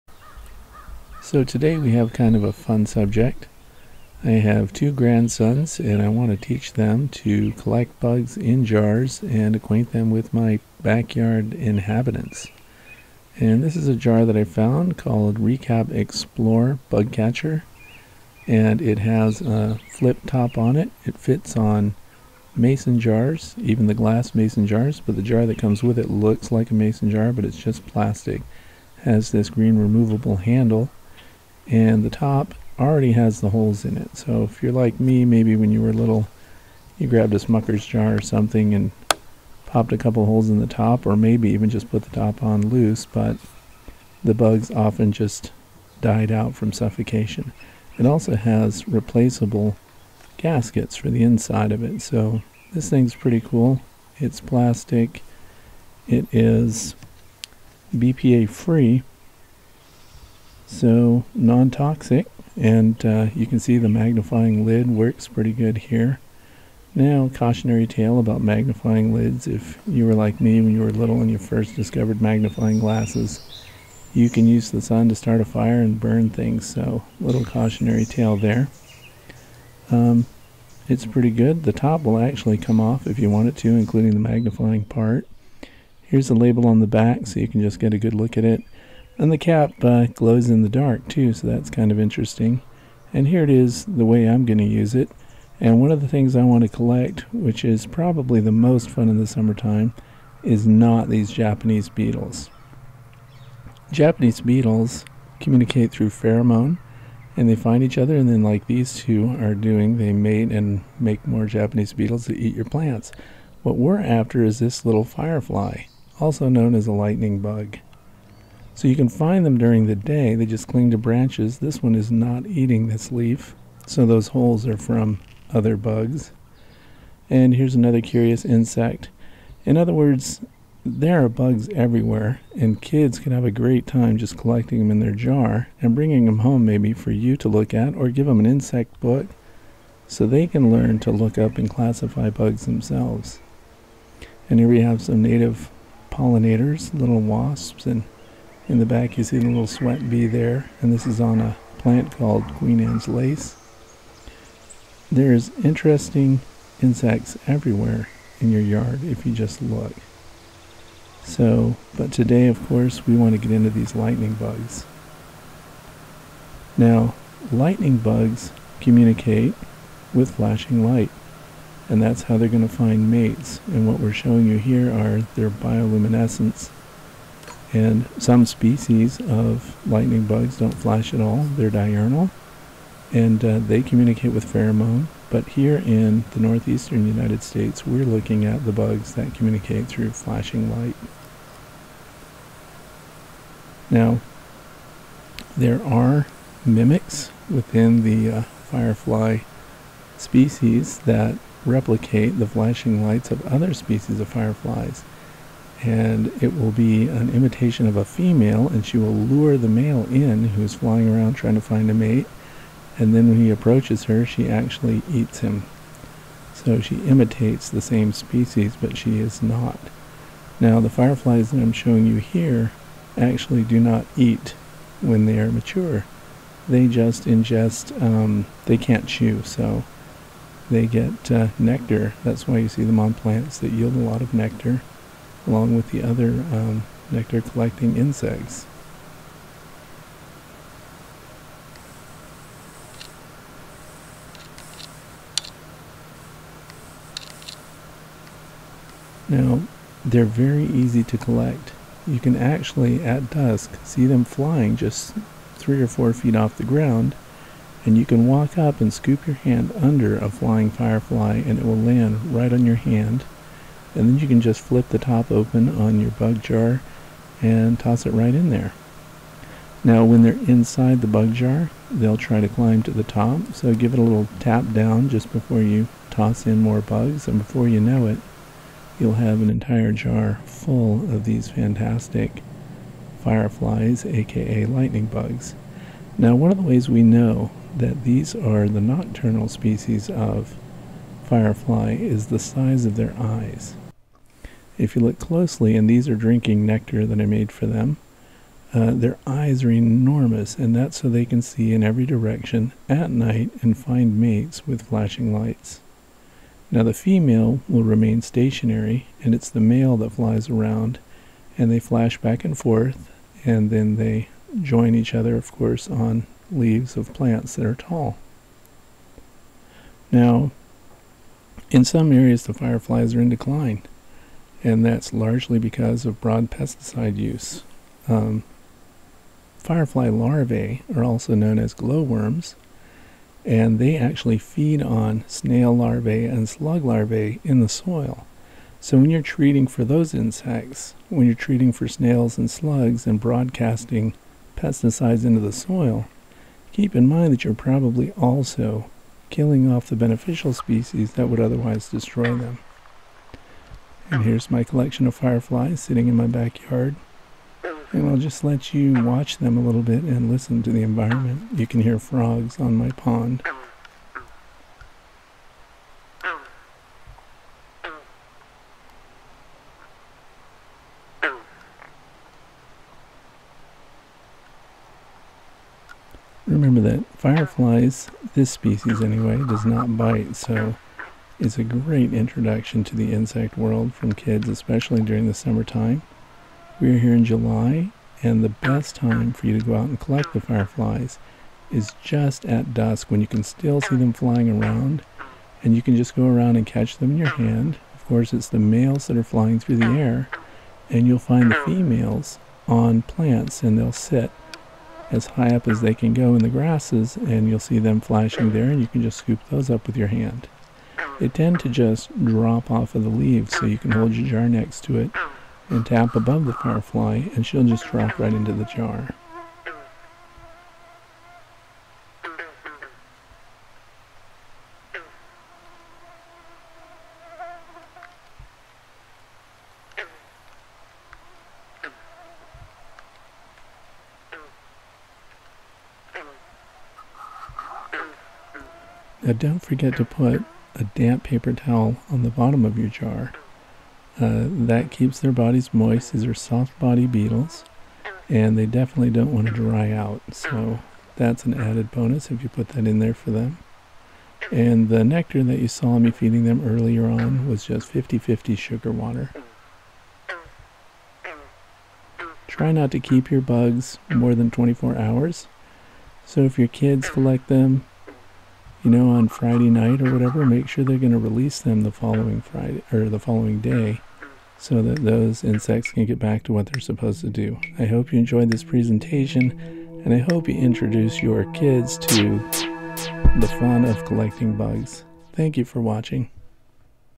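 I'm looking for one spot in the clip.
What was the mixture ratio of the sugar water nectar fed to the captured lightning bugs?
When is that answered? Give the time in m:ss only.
7:37.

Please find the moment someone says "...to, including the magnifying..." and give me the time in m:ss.
1:23.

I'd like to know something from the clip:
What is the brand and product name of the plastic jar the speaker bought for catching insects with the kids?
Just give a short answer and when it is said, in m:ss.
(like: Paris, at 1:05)
Recap Explore Bug Catcher, at 0:15.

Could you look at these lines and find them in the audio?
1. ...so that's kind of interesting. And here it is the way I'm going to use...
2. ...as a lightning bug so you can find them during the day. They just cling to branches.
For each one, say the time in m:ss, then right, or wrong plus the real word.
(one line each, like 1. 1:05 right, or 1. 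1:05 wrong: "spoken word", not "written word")
1. 1:31 right
2. 1:56 right.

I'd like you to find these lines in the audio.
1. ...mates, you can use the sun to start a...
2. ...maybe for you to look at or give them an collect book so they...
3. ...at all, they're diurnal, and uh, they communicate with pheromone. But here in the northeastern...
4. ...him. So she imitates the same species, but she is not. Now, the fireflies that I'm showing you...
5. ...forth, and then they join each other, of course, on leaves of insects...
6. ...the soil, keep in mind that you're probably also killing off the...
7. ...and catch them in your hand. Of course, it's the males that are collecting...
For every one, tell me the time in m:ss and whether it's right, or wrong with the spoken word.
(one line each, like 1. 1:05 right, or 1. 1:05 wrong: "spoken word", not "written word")
1. 1:12 wrong: "glasses", not "mates"
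2. 2:16 wrong: "insect", not "collect"
3. 3:01 right
4. 3:35 right
5. 5:12 wrong: "plants", not "insects"
6. 5:45 right
7. 6:36 wrong: "flying", not "collecting".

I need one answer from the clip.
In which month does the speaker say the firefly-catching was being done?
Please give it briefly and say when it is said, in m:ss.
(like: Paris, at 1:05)
July, at 6:27.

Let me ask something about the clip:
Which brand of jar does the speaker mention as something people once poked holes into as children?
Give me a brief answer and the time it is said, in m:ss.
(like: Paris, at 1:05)
Smucker's, at 0:37.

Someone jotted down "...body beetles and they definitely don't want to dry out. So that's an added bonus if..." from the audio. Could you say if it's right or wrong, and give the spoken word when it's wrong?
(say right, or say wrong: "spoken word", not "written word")
right.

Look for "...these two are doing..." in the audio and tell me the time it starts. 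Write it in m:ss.
1:48.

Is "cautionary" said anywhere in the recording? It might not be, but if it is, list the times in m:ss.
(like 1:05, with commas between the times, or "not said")
1:07, 1:17.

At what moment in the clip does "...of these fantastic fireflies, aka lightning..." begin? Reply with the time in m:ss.
4:41.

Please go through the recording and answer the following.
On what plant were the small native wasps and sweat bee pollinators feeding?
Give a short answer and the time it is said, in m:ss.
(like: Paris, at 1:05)
Queen Anne's Lace, at 2:32.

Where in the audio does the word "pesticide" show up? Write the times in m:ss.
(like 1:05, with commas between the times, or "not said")
5:26, 5:44.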